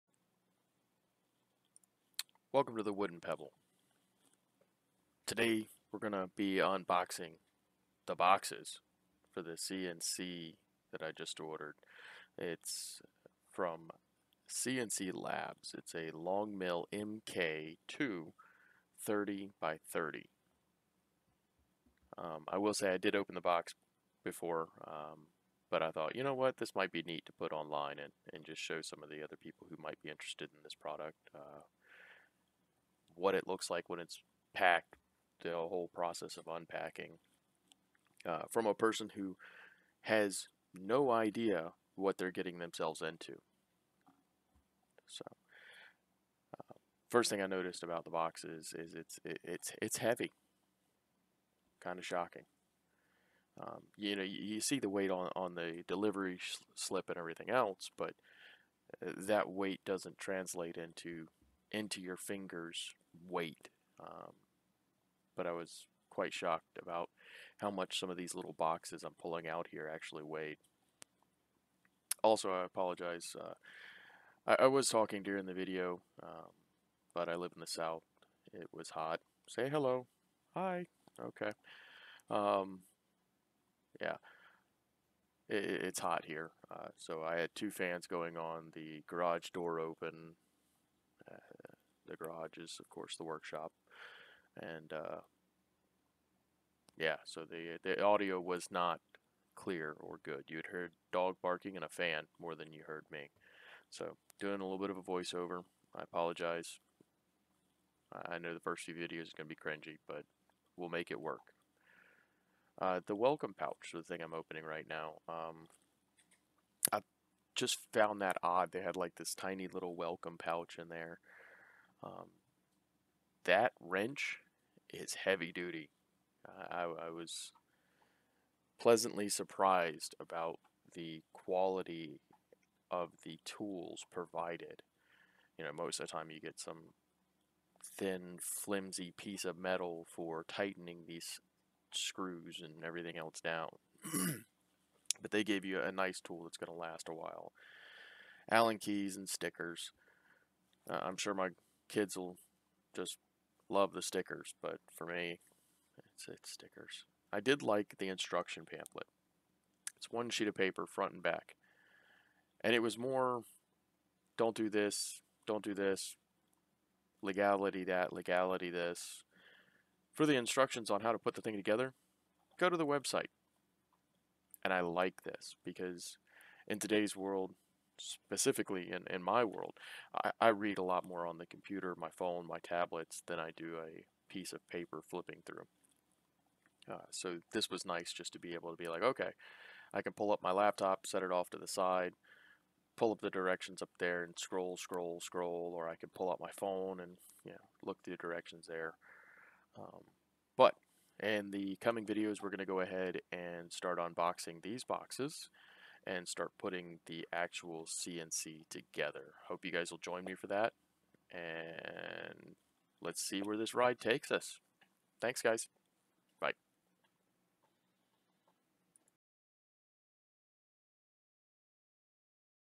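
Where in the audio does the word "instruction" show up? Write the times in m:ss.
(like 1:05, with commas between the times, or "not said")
2:38, 2:50.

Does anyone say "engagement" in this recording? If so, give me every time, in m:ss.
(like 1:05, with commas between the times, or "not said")
not said.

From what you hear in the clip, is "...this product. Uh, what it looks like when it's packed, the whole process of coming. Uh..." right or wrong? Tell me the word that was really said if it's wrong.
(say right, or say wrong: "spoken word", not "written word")
wrong: "unpacking", not "coming".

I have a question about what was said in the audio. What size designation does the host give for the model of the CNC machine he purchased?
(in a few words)
30 by 30.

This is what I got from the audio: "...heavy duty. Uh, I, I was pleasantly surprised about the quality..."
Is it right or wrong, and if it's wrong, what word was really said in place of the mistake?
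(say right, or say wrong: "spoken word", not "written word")
right.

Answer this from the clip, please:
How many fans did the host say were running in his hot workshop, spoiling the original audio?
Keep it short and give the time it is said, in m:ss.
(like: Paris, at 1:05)
2, at 1:27.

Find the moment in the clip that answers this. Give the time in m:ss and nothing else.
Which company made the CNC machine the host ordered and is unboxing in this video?
0:14.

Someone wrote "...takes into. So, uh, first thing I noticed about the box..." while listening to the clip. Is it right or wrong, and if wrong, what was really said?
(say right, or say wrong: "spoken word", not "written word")
wrong: "themselves", not "takes".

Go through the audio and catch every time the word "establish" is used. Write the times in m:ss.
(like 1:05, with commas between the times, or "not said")
not said.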